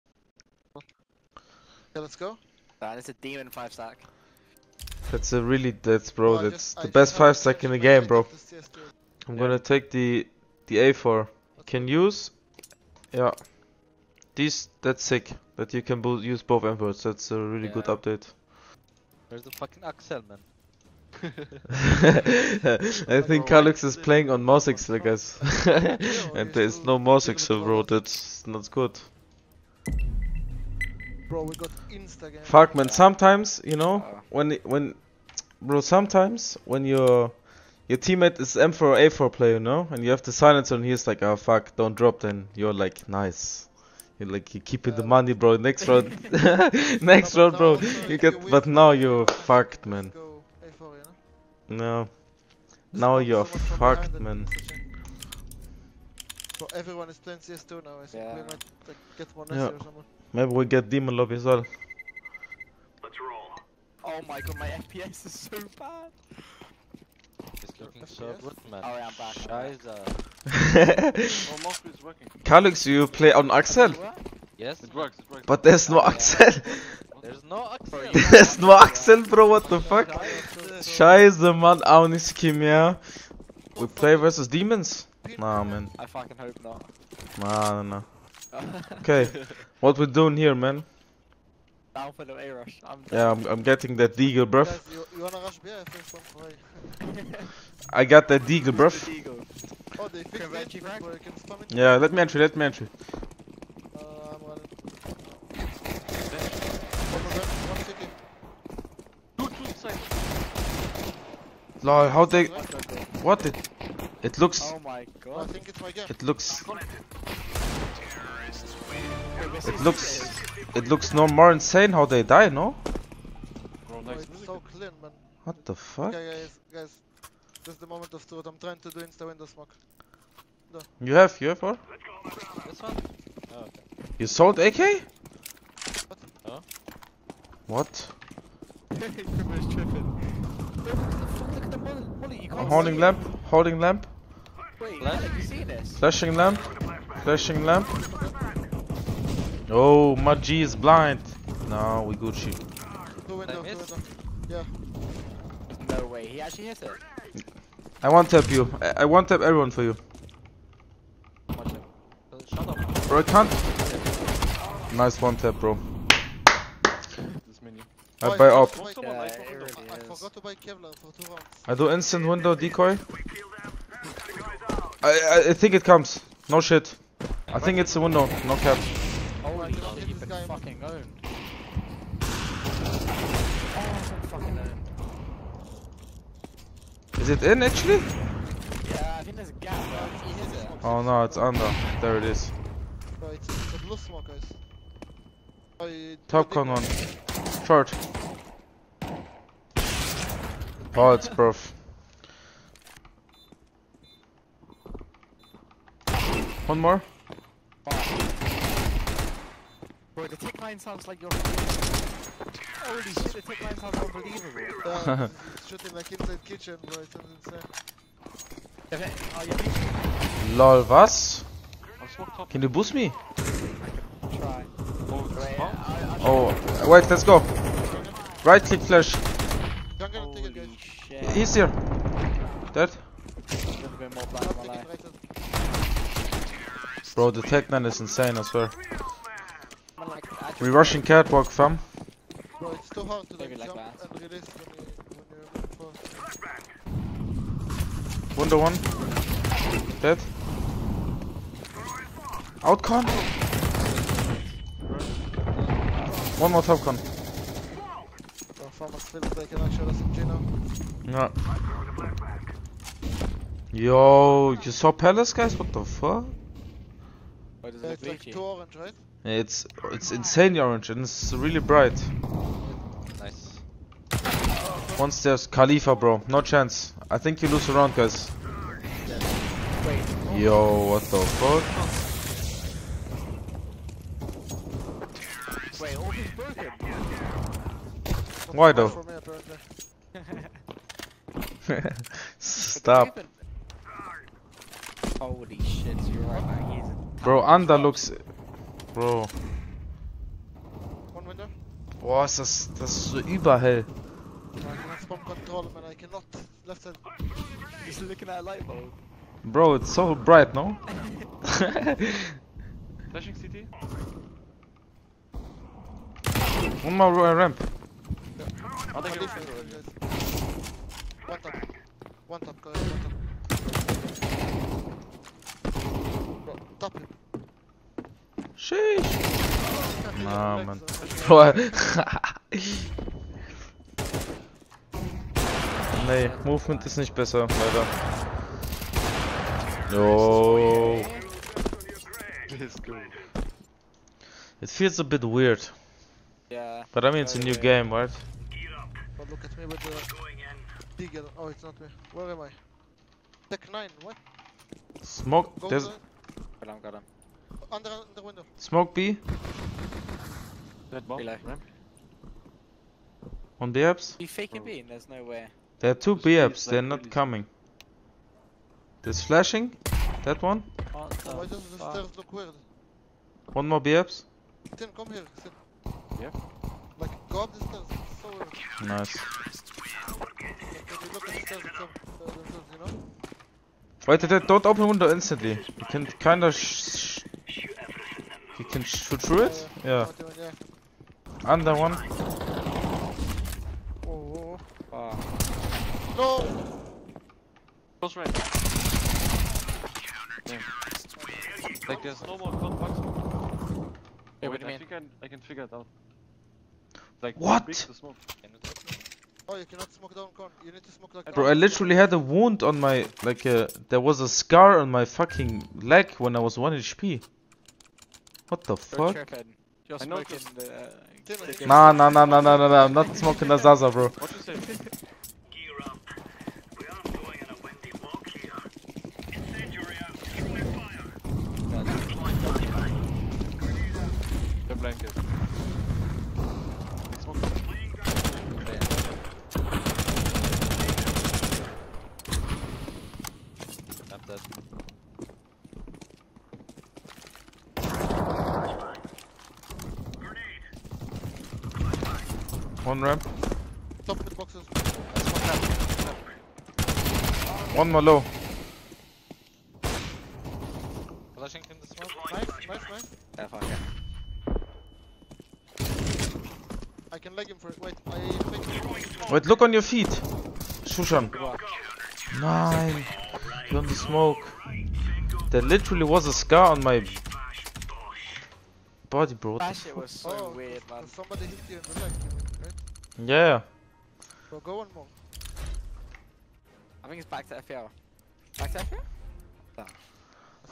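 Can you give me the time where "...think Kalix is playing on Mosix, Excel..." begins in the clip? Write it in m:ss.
0:23.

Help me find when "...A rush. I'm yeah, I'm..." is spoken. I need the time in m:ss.
1:32.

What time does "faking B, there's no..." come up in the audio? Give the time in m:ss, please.
6:04.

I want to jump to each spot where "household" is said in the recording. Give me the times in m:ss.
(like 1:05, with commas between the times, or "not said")
not said.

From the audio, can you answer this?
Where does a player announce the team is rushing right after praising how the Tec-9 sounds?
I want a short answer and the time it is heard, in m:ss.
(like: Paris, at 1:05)
Catwalk, at 4:01.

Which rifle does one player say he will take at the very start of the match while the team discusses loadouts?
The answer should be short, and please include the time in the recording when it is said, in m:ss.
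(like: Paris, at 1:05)
M4A4, at 0:10.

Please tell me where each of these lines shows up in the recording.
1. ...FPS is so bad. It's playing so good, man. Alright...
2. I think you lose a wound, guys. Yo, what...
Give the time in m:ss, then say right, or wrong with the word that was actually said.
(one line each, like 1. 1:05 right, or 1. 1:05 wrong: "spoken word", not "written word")
1. 1:04 wrong: "looking", not "playing"
2. 4:37 wrong: "round", not "wound".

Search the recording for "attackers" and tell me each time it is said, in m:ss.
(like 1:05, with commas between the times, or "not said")
not said.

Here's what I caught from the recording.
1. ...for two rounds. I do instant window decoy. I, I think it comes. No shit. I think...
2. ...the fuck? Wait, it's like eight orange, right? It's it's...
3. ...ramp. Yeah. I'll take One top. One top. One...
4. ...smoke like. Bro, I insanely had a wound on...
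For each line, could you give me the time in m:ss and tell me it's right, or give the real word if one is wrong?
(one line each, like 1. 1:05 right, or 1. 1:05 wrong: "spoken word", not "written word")
1. 2:50 right
2. 4:25 wrong: "two", not "eight"
3. 5:17 right
4. 6:50 wrong: "literally", not "insanely".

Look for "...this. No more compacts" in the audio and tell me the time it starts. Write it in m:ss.
6:42.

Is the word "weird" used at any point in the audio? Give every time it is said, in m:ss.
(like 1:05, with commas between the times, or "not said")
5:45, 6:12, 6:18, 8:00.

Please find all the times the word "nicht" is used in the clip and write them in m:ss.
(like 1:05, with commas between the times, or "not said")
1:22, 5:36.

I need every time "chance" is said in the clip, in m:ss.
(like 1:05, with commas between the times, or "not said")
4:36.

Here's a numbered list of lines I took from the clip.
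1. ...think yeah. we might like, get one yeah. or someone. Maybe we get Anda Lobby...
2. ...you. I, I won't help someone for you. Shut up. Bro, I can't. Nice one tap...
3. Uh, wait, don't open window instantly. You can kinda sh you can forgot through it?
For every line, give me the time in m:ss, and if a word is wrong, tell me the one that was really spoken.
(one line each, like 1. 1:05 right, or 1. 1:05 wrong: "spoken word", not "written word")
1. 0:58 wrong: "Demon", not "Anda"
2. 2:38 wrong: "everyone", not "someone"
3. 6:22 wrong: "shoot", not "forgot".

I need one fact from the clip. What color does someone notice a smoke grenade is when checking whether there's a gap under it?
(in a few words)
Blue.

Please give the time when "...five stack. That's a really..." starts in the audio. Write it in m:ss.
0:03.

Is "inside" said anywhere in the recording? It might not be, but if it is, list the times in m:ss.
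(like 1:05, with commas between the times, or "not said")
3:36.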